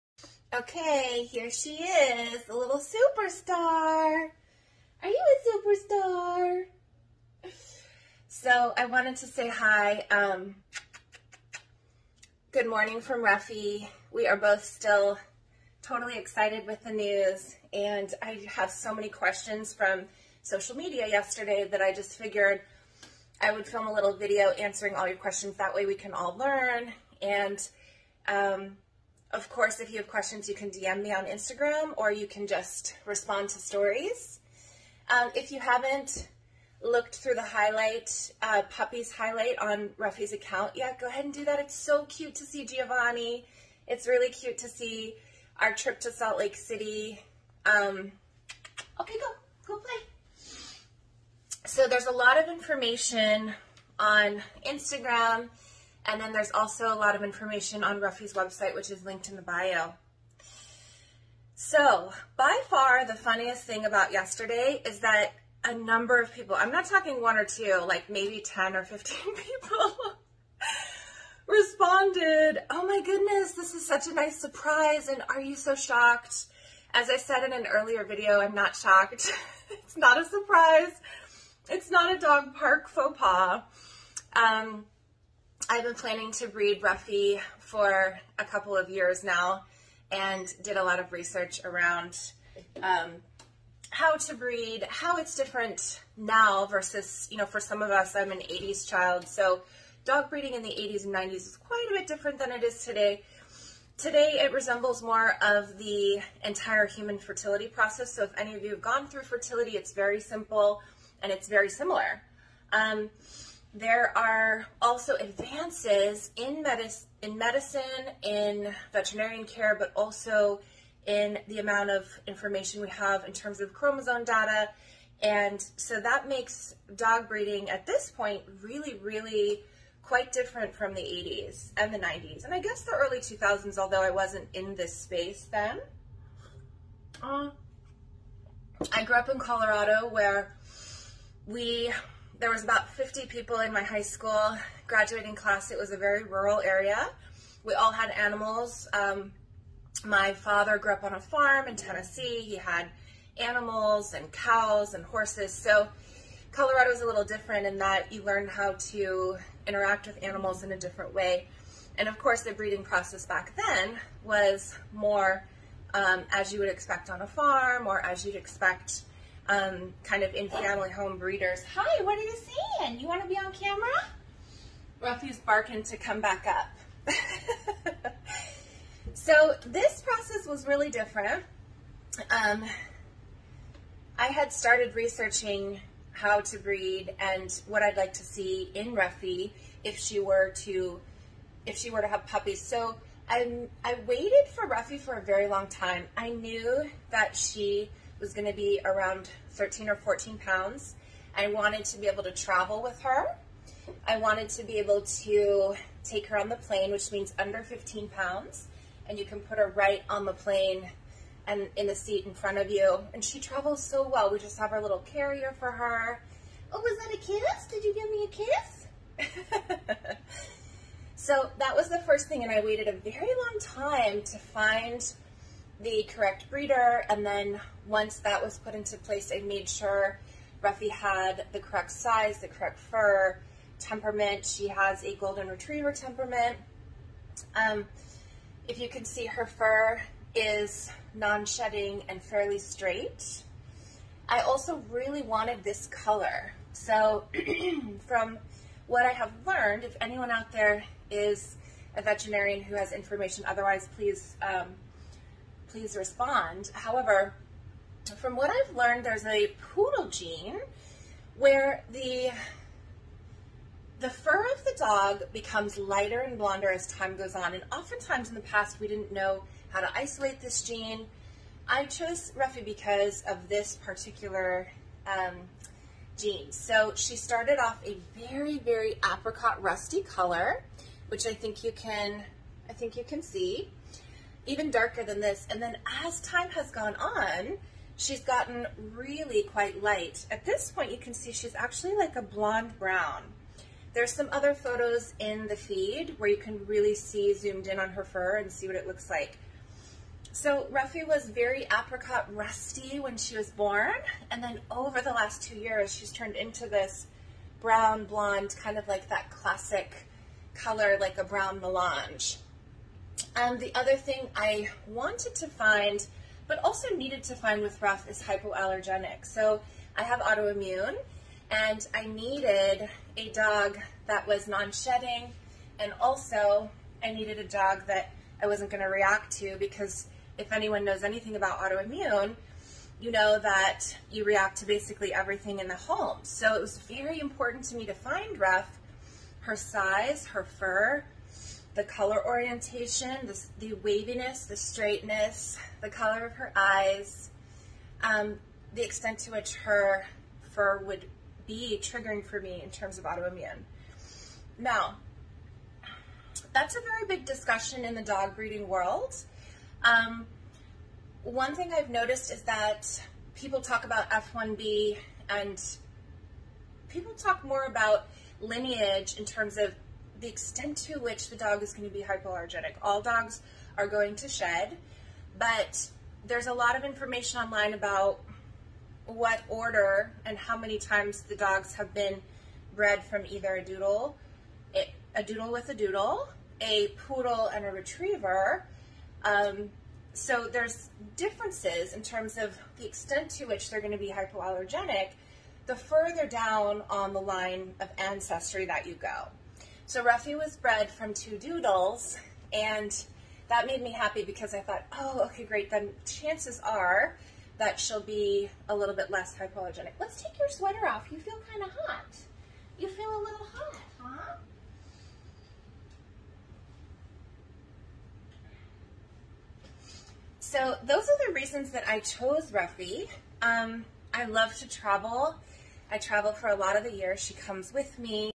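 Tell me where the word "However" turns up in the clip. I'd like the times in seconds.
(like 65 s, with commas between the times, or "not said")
256 s.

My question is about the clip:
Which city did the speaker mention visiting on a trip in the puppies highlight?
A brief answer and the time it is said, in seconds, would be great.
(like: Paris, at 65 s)
Salt Lake City, at 46 s.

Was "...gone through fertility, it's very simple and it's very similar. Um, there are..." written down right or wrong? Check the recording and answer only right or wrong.
right.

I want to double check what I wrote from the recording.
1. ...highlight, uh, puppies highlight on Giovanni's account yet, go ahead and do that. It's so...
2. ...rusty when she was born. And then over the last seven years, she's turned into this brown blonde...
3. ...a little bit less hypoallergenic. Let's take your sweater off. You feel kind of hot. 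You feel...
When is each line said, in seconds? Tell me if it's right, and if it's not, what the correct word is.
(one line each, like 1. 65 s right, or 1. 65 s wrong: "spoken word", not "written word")
1. 37 s wrong: "Ruffie", not "Giovanni"
2. 302 s wrong: "two", not "seven"
3. 408 s right.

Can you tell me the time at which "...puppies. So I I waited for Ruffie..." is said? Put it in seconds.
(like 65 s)
192 s.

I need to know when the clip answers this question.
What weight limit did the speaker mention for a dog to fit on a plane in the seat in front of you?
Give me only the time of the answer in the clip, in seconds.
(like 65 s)
207 s.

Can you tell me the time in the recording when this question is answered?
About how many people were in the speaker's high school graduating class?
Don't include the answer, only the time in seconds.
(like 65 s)
142 s.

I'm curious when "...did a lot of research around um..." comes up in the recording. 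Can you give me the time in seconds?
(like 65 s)
90 s.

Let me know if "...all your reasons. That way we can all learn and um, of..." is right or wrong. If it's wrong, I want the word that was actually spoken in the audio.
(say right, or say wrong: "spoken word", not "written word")
wrong: "questions", not "reasons".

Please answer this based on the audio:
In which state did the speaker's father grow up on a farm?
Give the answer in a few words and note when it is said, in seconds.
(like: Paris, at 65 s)
Tennessee, at 151 s.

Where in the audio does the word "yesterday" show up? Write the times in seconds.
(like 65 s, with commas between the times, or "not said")
21 s, 64 s.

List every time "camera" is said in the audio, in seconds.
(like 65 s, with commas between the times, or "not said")
173 s.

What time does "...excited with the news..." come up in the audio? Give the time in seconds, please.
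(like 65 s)
16 s.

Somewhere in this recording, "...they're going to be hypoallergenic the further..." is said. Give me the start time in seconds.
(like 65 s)
393 s.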